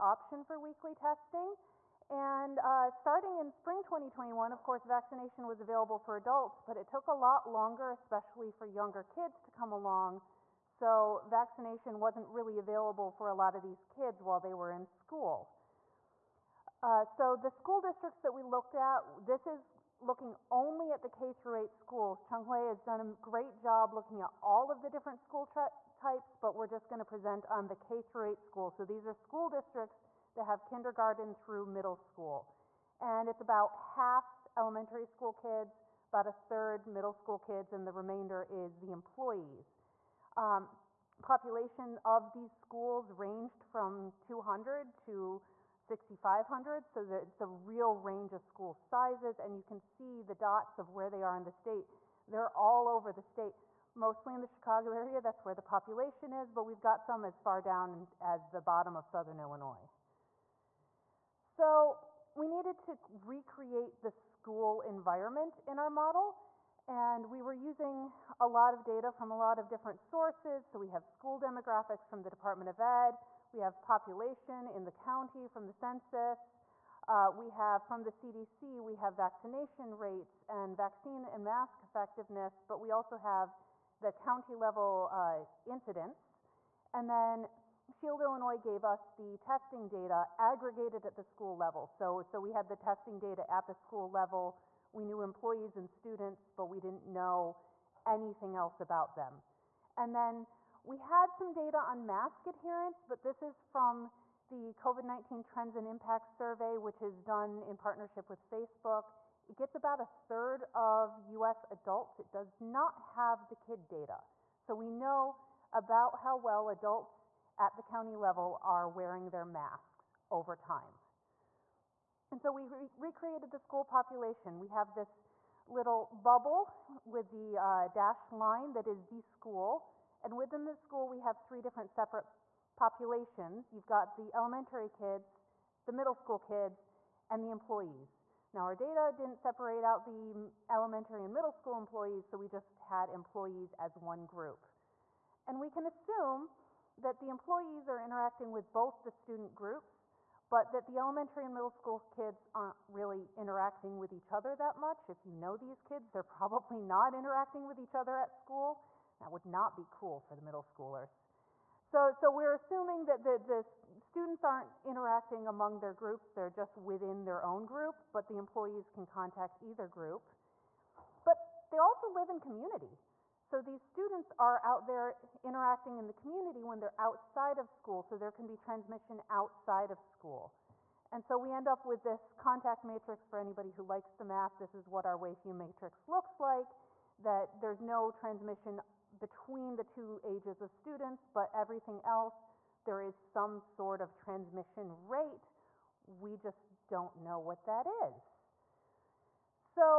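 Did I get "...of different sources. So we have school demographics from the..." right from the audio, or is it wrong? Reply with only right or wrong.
right.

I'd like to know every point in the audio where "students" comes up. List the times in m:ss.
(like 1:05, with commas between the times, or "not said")
1:35, 2:29, 2:43, 2:53, 3:10.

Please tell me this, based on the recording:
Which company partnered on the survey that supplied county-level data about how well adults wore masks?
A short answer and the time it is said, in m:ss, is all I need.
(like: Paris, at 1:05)
Facebook, at 1:48.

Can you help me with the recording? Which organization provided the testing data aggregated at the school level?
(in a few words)
Shield Illinois.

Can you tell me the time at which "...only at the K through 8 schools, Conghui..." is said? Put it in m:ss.
0:20.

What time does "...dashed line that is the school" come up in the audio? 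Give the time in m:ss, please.
2:07.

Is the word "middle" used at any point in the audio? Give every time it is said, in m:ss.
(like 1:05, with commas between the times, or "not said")
0:31, 0:36, 2:15, 2:21, 2:31, 2:40.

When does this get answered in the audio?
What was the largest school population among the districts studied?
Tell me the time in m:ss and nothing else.
0:45.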